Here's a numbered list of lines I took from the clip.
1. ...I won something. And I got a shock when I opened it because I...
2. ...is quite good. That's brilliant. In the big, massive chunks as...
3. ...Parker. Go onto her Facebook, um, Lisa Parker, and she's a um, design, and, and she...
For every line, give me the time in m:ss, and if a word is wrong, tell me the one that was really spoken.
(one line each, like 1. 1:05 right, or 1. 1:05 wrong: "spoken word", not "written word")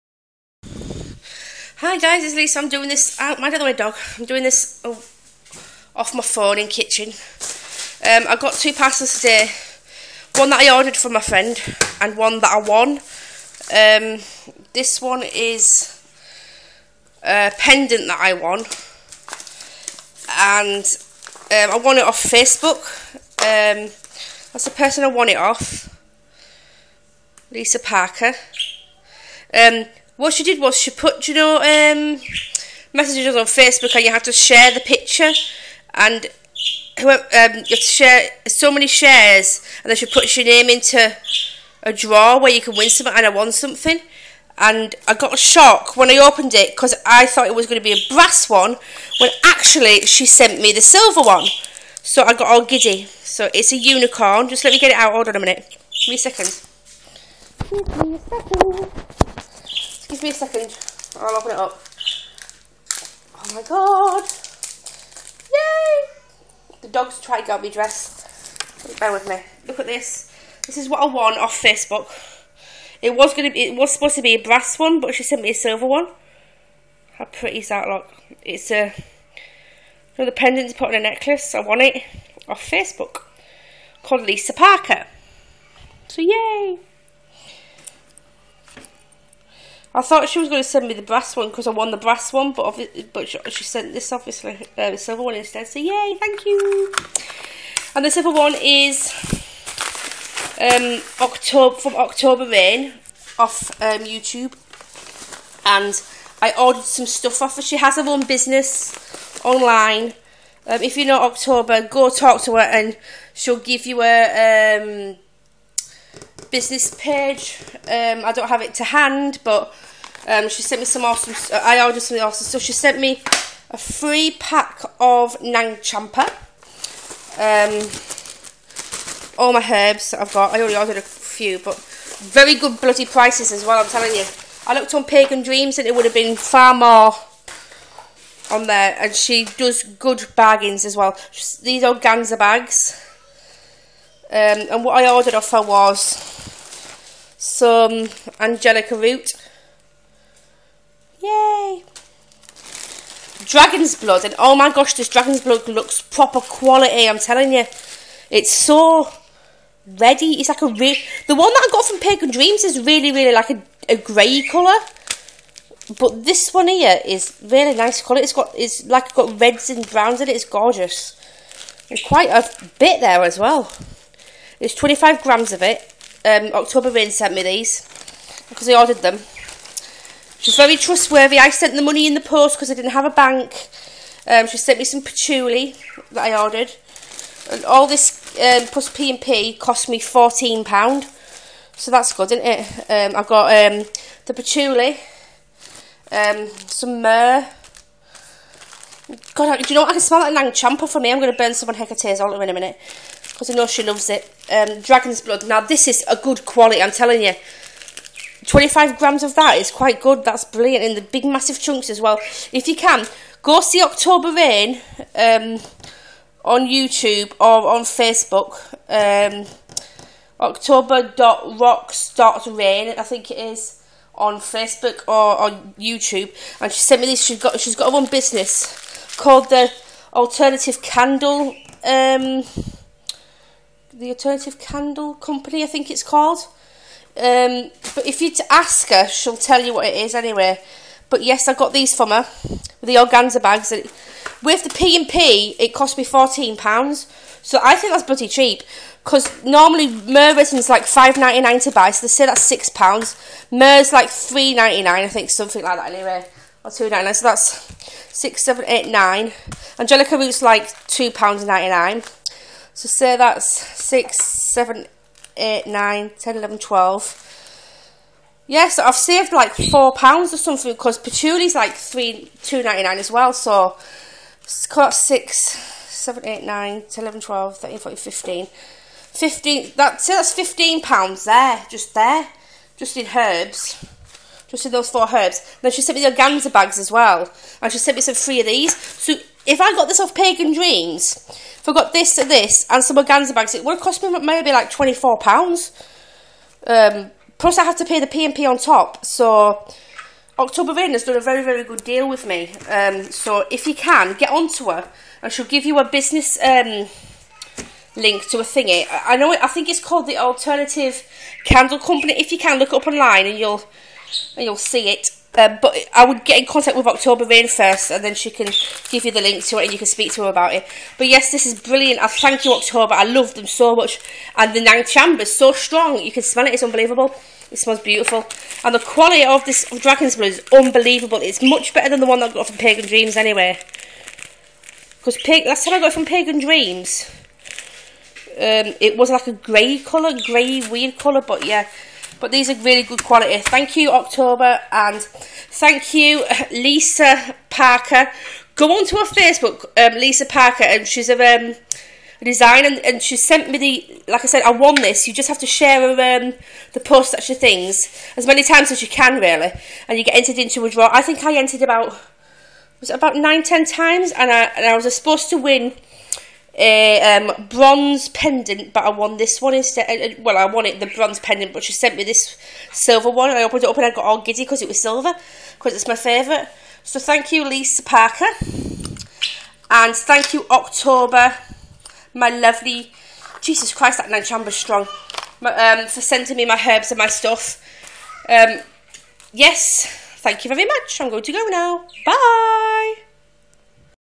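1. 0:43 right
2. 3:29 right
3. 5:47 right.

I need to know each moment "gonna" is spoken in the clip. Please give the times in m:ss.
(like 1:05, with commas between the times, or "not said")
1:13.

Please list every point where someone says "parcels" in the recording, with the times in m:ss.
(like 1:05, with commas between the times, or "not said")
0:08.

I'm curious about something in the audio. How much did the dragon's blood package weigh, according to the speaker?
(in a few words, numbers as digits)
25 grams.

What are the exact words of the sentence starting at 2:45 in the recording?
But this one here is really nice colour.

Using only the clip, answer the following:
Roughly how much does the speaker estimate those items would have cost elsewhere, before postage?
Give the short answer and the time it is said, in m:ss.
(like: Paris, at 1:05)
£24, at 4:54.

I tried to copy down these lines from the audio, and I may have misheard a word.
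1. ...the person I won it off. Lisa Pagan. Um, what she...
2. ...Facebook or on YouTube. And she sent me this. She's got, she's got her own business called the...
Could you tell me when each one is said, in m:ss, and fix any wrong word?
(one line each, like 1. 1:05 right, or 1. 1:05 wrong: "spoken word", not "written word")
1. 0:24 wrong: "Parker", not "Pagan"
2. 3:44 right.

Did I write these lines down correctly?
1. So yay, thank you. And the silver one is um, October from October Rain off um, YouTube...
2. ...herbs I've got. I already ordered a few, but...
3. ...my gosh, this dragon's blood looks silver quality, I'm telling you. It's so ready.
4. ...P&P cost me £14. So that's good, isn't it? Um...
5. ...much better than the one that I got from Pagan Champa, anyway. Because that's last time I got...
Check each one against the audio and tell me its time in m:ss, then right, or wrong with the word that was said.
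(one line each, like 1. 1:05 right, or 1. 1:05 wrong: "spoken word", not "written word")
1. 1:35 right
2. 2:09 right
3. 2:34 wrong: "proper", not "silver"
4. 3:08 right
5. 5:31 wrong: "Dreams", not "Champa".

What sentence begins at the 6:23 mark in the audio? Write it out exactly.
Jesus Christ, that nine Chambers strong.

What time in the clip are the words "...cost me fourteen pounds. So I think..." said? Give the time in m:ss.
4:05.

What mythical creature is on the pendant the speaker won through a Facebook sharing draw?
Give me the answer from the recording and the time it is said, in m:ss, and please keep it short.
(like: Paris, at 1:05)
Unicorn, at 0:53.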